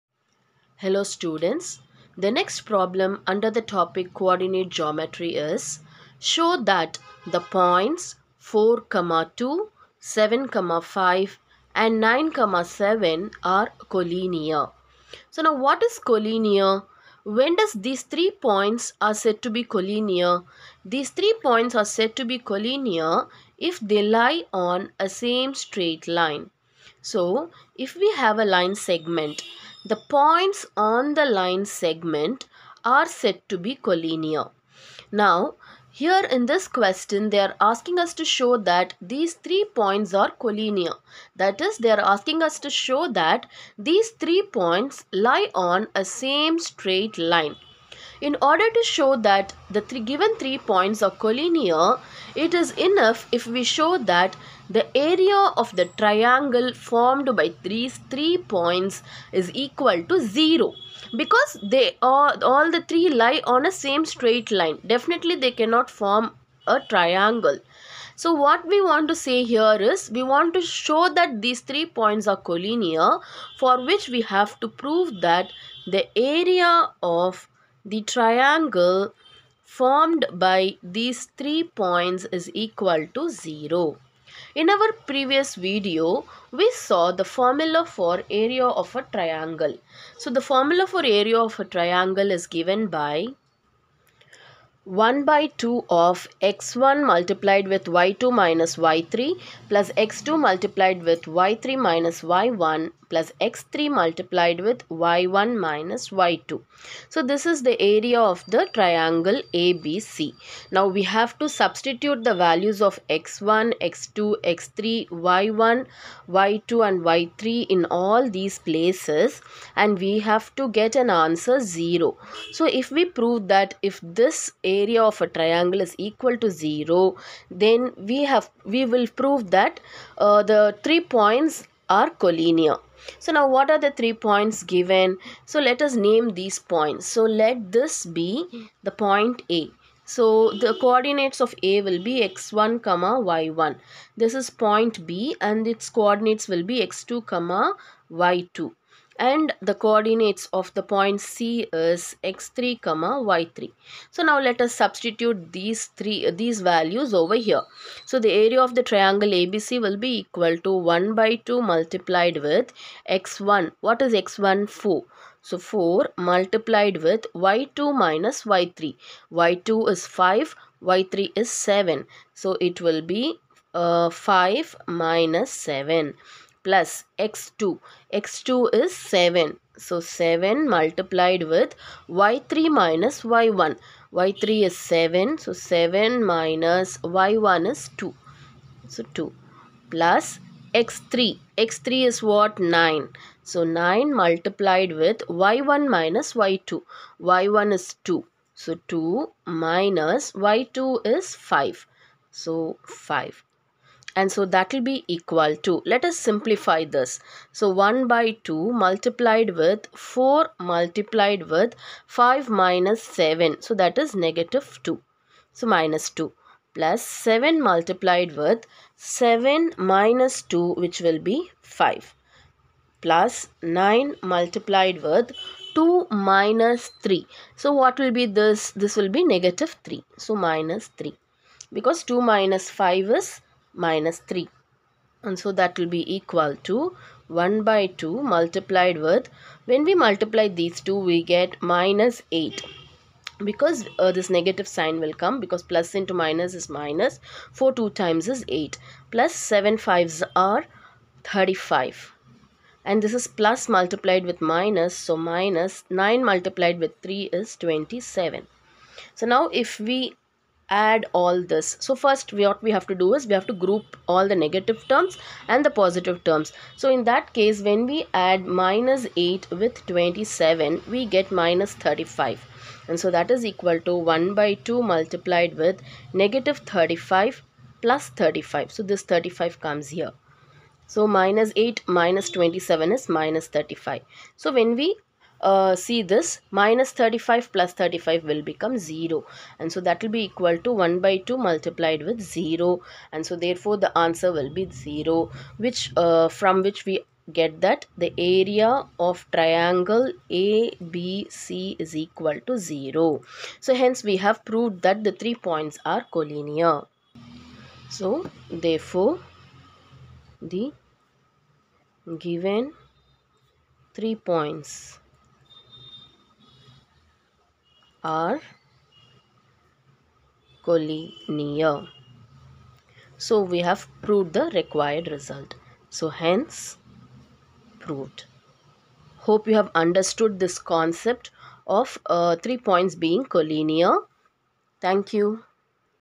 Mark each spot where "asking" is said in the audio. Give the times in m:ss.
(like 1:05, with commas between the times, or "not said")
0:37, 0:41.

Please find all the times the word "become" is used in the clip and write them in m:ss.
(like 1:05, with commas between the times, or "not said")
4:48.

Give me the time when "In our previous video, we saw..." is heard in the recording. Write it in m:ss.
1:24.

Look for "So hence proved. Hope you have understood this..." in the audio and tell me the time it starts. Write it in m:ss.
5:25.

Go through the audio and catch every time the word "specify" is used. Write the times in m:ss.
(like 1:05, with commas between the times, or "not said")
not said.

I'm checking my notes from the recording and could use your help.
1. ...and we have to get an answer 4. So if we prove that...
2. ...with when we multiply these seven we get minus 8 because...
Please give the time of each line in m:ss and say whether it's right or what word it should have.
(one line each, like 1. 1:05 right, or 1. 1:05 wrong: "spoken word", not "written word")
1. 1:59 wrong: "0", not "4"
2. 3:58 wrong: "two", not "seven".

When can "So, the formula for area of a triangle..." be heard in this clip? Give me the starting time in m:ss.
1:30.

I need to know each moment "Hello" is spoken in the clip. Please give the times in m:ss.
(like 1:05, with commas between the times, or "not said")
0:00.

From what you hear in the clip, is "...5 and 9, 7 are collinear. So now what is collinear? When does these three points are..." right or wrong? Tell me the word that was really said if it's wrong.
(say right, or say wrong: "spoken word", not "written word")
right.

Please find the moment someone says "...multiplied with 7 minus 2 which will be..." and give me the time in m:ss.
3:37.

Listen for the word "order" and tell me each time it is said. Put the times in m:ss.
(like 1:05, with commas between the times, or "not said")
0:48.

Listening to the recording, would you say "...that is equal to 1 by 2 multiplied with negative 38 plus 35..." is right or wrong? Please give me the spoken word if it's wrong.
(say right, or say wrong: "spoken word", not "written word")
wrong: "35", not "38".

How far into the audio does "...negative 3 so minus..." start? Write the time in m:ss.
3:49.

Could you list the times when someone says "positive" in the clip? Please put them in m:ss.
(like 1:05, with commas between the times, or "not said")
4:25.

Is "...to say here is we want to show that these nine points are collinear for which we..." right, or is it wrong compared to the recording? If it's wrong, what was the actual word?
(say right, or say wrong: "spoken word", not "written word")
wrong: "three", not "nine".